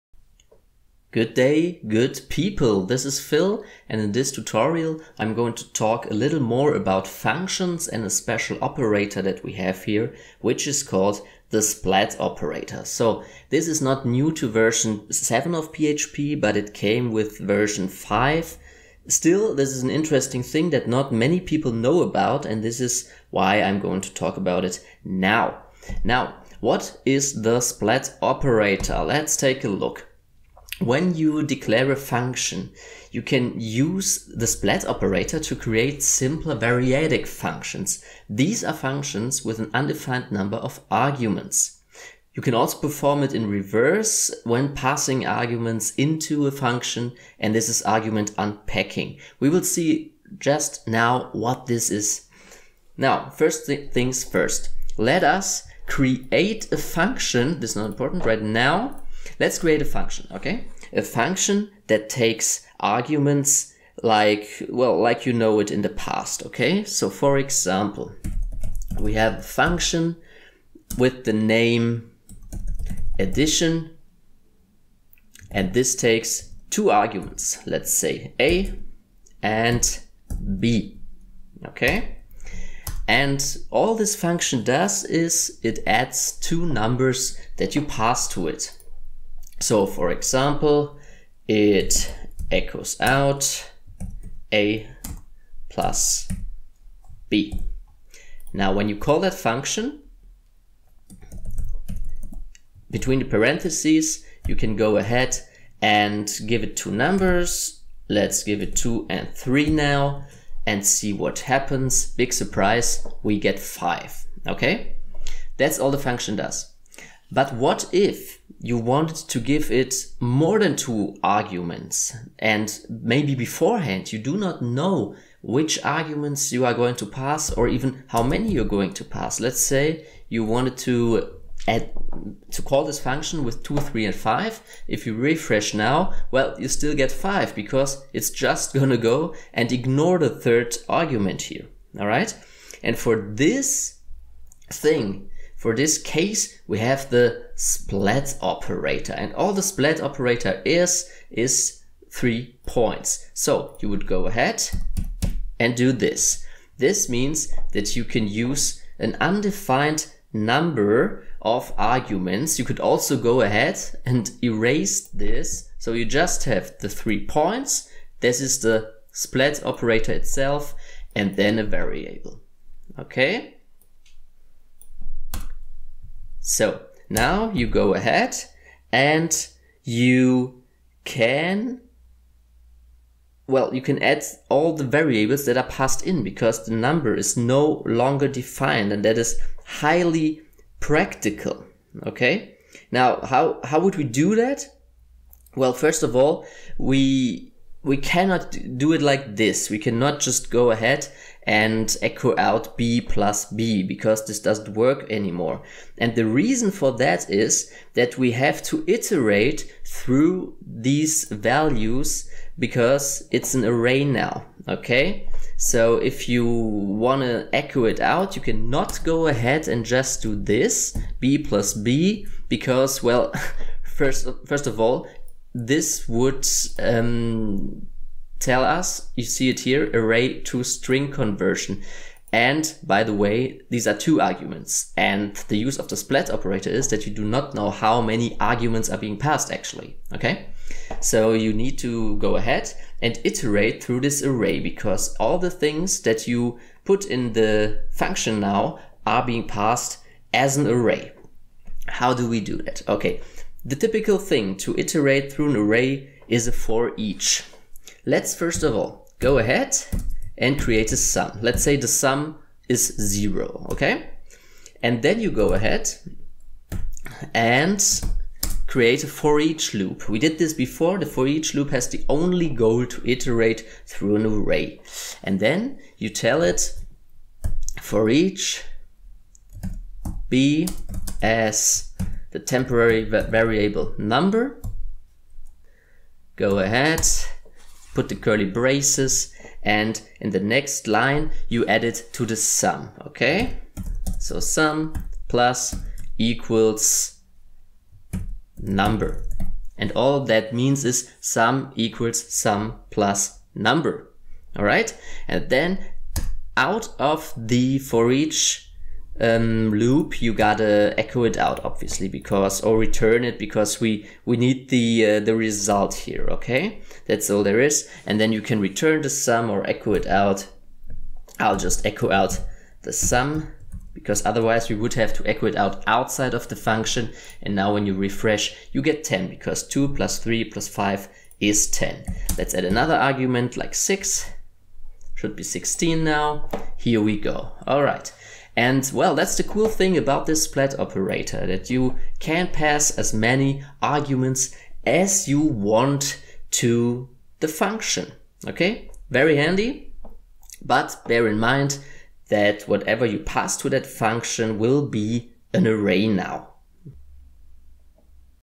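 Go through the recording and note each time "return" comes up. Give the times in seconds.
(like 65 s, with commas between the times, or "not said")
312 s, 318 s.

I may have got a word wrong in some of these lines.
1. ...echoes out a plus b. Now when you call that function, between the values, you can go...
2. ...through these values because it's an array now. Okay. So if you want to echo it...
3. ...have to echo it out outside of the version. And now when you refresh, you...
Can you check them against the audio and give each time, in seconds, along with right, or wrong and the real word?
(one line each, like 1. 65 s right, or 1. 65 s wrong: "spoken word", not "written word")
1. 92 s wrong: "parentheses", not "values"
2. 209 s right
3. 324 s wrong: "function", not "version".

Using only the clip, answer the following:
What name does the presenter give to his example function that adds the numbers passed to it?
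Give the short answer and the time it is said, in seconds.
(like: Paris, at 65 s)
addition, at 73 s.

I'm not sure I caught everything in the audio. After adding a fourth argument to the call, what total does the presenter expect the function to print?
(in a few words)
16.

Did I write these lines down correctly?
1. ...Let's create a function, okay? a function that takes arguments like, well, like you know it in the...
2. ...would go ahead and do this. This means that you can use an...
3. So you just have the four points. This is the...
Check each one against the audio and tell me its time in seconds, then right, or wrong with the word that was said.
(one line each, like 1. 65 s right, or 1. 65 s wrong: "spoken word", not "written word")
1. 59 s right
2. 153 s right
3. 165 s wrong: "three", not "four".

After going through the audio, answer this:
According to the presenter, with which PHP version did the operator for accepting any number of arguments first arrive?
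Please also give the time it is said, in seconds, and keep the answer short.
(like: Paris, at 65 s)
version 5, at 17 s.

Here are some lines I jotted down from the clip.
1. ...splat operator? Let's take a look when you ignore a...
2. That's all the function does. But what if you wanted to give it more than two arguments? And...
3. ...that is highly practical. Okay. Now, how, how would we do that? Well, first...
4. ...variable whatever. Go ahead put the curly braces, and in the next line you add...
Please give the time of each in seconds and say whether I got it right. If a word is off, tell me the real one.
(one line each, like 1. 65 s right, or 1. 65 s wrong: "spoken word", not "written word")
1. 27 s wrong: "declare", not "ignore"
2. 115 s right
3. 189 s right
4. 283 s wrong: "number", not "whatever".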